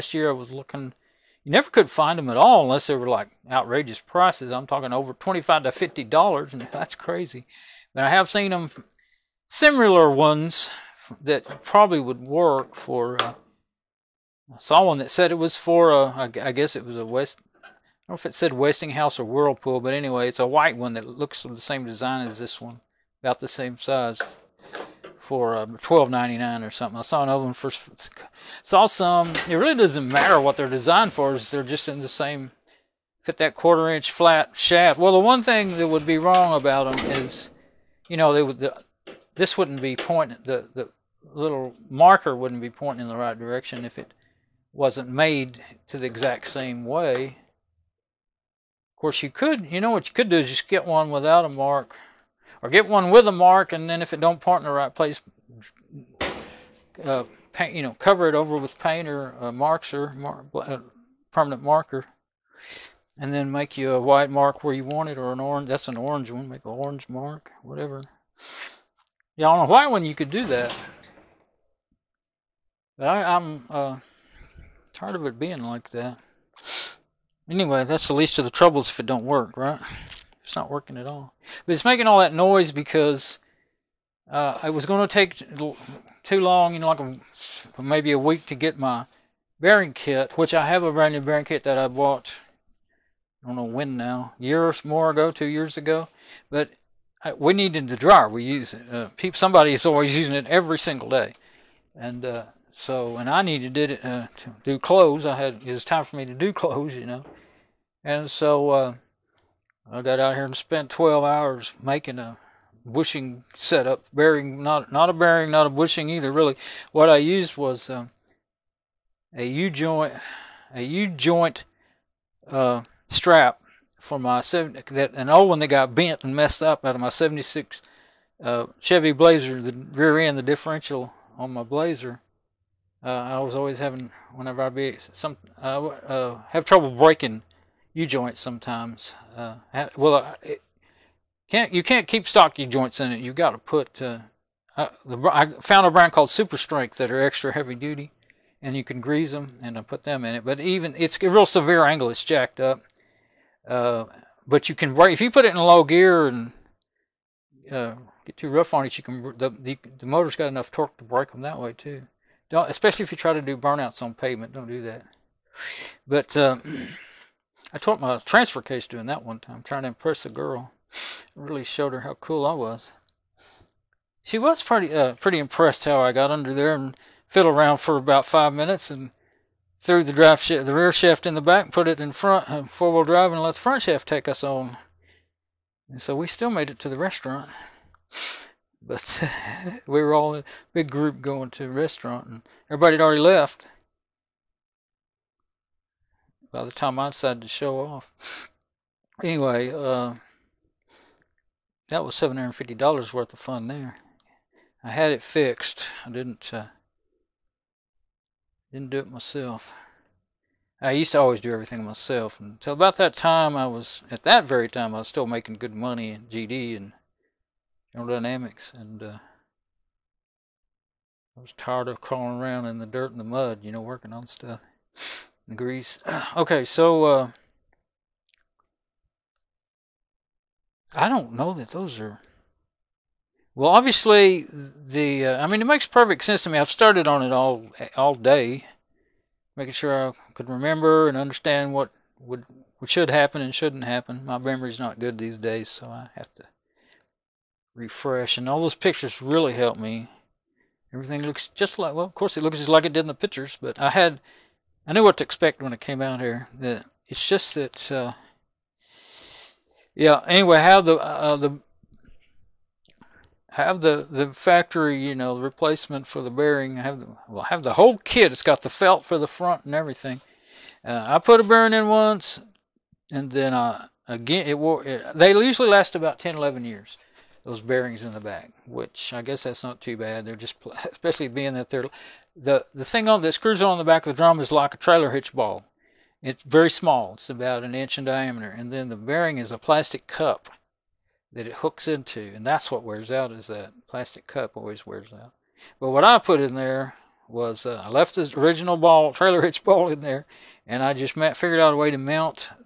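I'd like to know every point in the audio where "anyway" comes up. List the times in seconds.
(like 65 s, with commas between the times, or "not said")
19 s, 77 s, 199 s, 260 s.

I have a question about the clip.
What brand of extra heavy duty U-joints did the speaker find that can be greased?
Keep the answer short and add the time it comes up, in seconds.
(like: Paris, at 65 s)
Super Strength, at 146 s.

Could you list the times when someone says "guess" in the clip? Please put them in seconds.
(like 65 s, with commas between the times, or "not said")
16 s, 279 s.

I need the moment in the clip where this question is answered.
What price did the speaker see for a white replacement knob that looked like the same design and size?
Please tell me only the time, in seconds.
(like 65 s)
25 s.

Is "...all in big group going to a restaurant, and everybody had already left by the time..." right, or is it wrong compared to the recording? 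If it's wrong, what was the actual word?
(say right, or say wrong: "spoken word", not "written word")
right.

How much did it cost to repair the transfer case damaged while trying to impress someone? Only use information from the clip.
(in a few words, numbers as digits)
$750.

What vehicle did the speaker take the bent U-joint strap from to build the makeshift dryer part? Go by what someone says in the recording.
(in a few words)
76 Chevy Blazer.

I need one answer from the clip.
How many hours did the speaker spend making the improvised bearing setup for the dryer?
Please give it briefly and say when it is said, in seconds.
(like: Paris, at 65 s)
12, at 110 s.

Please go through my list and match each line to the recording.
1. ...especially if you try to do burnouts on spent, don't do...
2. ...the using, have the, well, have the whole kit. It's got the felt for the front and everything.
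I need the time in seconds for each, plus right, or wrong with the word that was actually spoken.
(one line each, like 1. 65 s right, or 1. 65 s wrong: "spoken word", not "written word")
1. 162 s wrong: "pavement", not "spent"
2. 266 s wrong: "bearing", not "using".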